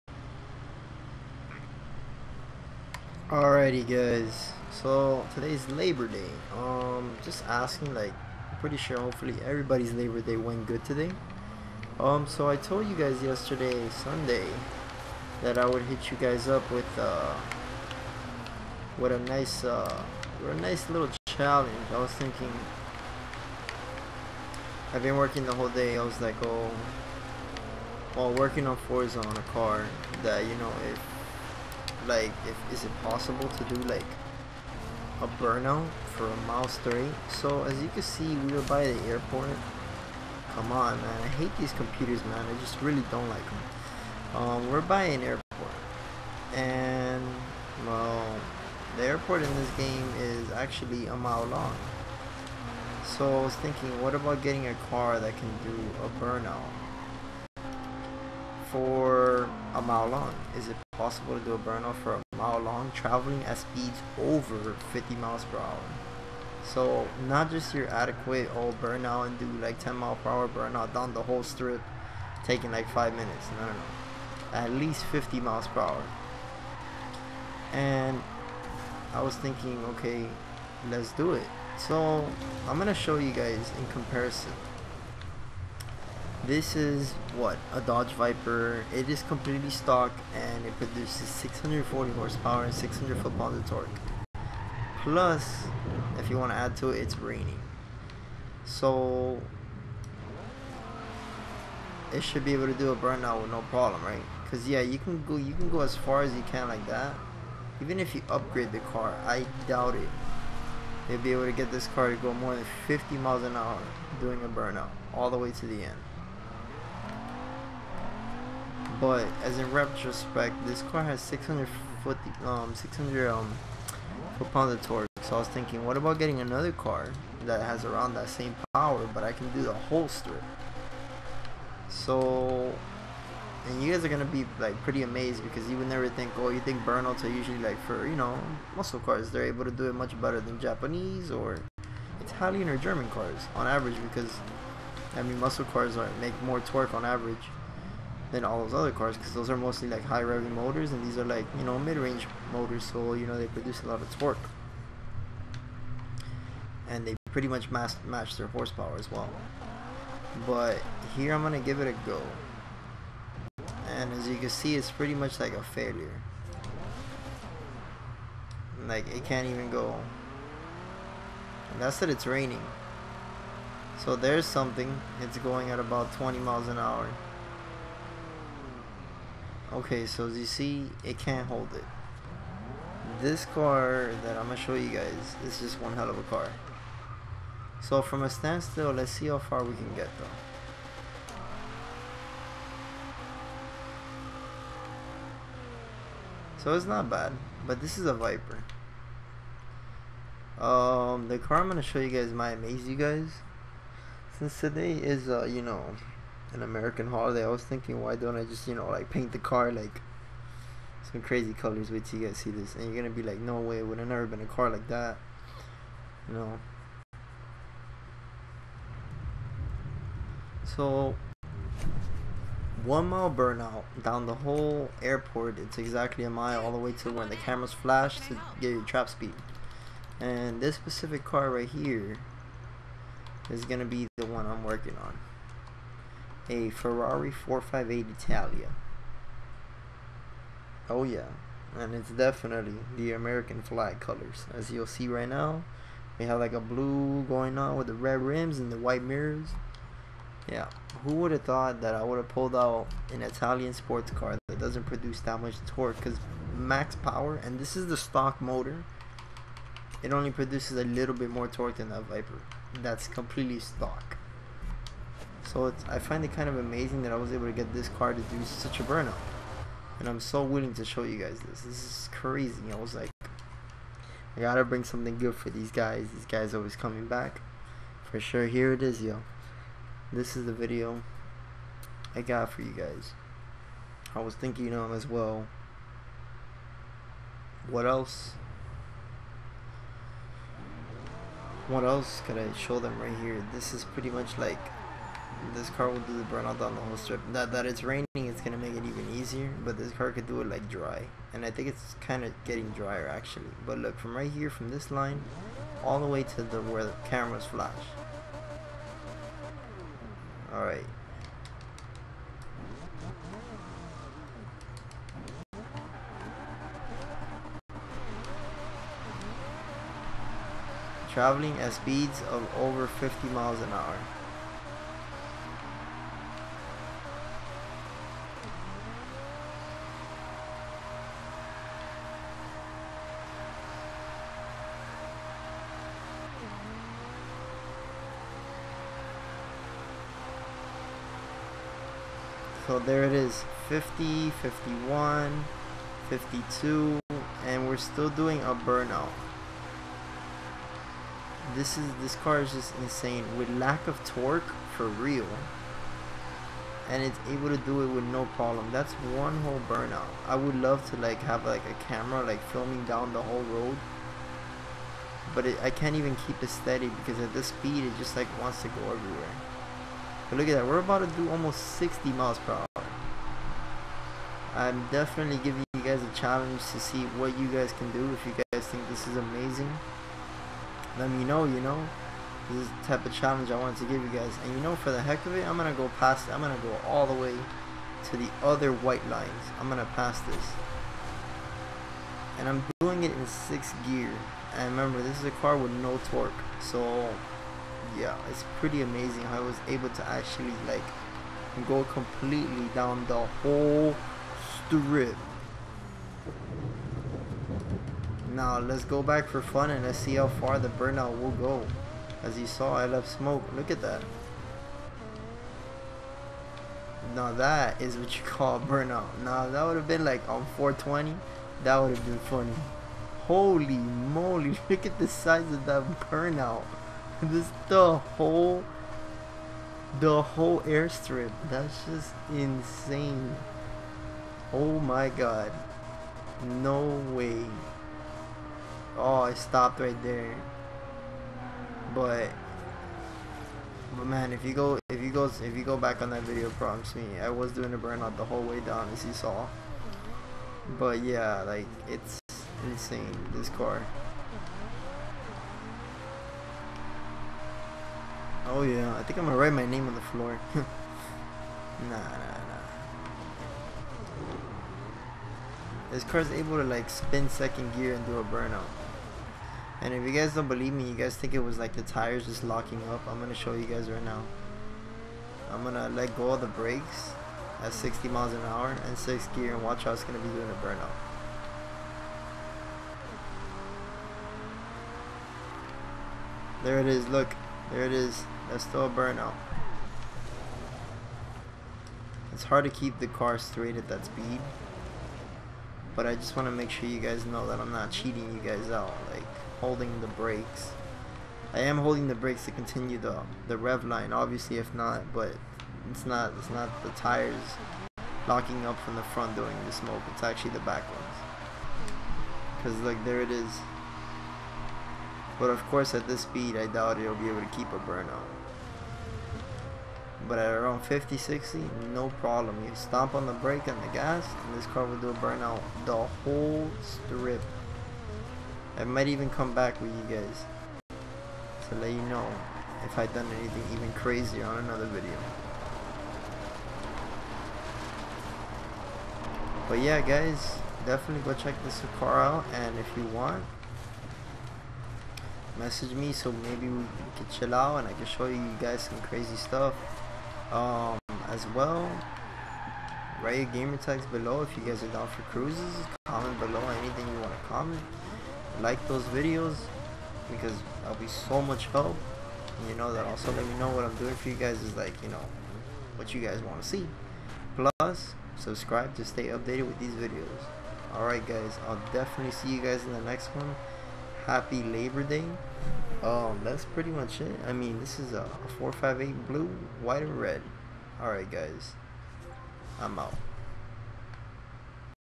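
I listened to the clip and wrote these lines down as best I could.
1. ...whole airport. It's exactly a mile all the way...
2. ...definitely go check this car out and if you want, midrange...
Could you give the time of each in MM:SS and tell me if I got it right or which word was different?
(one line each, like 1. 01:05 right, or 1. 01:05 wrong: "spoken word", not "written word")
1. 03:44 right
2. 09:00 wrong: "message", not "midrange".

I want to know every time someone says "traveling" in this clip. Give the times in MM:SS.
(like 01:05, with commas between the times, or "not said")
01:02, 05:21.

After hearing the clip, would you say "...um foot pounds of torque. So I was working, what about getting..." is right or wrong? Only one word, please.
wrong.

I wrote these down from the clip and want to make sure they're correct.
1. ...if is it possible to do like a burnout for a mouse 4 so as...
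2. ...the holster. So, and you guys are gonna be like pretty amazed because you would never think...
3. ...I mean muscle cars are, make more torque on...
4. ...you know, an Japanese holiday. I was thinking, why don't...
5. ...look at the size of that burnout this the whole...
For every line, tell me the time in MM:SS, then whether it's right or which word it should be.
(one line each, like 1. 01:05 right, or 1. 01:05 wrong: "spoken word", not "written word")
1. 00:32 wrong: "3", not "4"
2. 02:09 right
3. 02:25 right
4. 03:25 wrong: "American", not "Japanese"
5. 07:04 right.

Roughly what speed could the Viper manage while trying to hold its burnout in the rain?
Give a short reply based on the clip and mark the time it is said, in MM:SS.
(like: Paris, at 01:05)
20 miles an hour, at 02:56.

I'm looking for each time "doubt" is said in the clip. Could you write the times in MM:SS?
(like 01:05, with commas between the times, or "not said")
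01:49, 08:36.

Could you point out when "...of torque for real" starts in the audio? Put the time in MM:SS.
05:53.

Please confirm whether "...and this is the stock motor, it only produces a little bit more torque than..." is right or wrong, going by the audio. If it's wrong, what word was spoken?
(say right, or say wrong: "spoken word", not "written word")
right.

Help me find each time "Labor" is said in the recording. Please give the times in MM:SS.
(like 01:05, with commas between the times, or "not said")
00:05, 00:09, 09:34.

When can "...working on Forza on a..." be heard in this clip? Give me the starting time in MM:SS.
00:28.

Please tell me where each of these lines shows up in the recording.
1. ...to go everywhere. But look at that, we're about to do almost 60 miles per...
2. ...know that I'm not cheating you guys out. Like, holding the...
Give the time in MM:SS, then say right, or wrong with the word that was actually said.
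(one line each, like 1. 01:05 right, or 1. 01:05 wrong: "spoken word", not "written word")
1. 06:08 right
2. 08:17 right.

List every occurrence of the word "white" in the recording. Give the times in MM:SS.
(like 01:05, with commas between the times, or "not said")
04:08, 06:28, 09:39.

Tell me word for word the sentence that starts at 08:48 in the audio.
I might even come back with you guys to let you know if I've done anything even crazier on another video.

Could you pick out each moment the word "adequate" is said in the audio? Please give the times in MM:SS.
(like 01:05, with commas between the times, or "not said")
01:07.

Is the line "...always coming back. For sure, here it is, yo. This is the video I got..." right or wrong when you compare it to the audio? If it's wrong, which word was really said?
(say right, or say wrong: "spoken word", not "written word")
right.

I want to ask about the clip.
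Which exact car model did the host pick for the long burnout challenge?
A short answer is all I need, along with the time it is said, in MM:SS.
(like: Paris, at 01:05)
Ferrari 458 Italia, at 03:56.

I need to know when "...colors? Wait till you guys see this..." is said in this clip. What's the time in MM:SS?
03:31.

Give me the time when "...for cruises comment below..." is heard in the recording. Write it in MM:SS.
09:15.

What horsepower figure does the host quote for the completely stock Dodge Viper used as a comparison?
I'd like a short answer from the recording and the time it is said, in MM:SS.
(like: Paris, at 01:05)
640, at 01:31.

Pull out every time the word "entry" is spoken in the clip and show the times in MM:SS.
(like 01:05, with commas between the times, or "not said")
not said.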